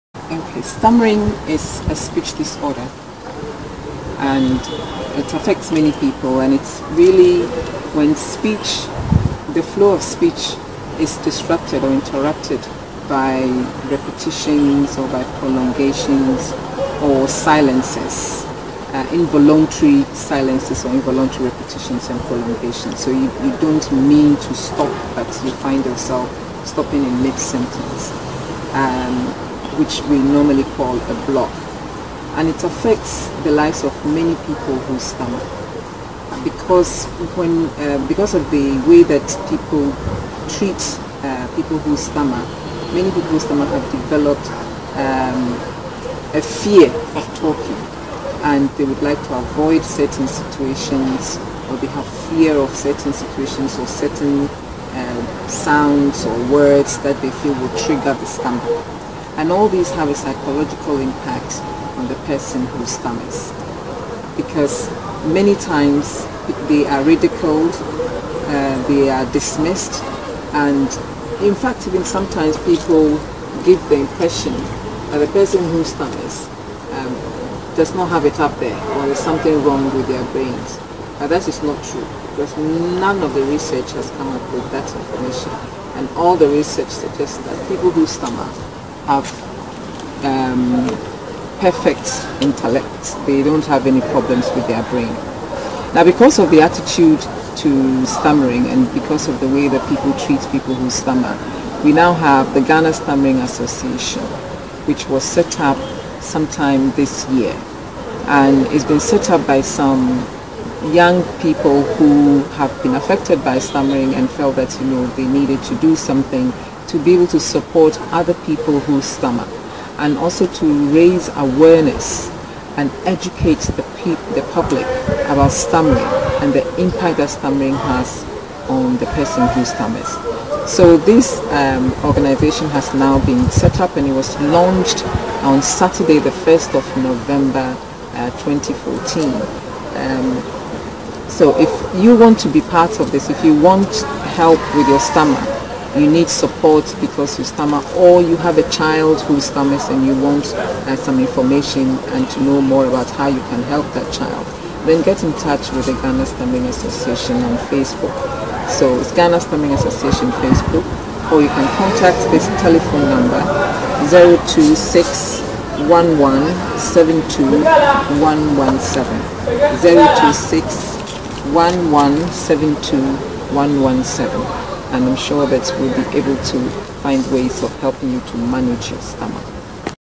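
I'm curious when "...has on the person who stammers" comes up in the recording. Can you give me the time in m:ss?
2:07.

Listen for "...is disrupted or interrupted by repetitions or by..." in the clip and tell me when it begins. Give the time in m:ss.
0:11.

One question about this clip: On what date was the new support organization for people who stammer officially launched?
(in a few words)
Saturday 1 November 2014.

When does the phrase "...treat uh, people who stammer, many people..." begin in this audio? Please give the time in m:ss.
0:40.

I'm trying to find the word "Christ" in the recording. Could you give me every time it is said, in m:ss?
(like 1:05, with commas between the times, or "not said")
not said.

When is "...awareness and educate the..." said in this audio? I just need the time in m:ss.
2:01.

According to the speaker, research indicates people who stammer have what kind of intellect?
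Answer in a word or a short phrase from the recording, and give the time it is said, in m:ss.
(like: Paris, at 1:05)
perfect intellect, at 1:31.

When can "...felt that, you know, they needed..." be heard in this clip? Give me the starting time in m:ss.
1:54.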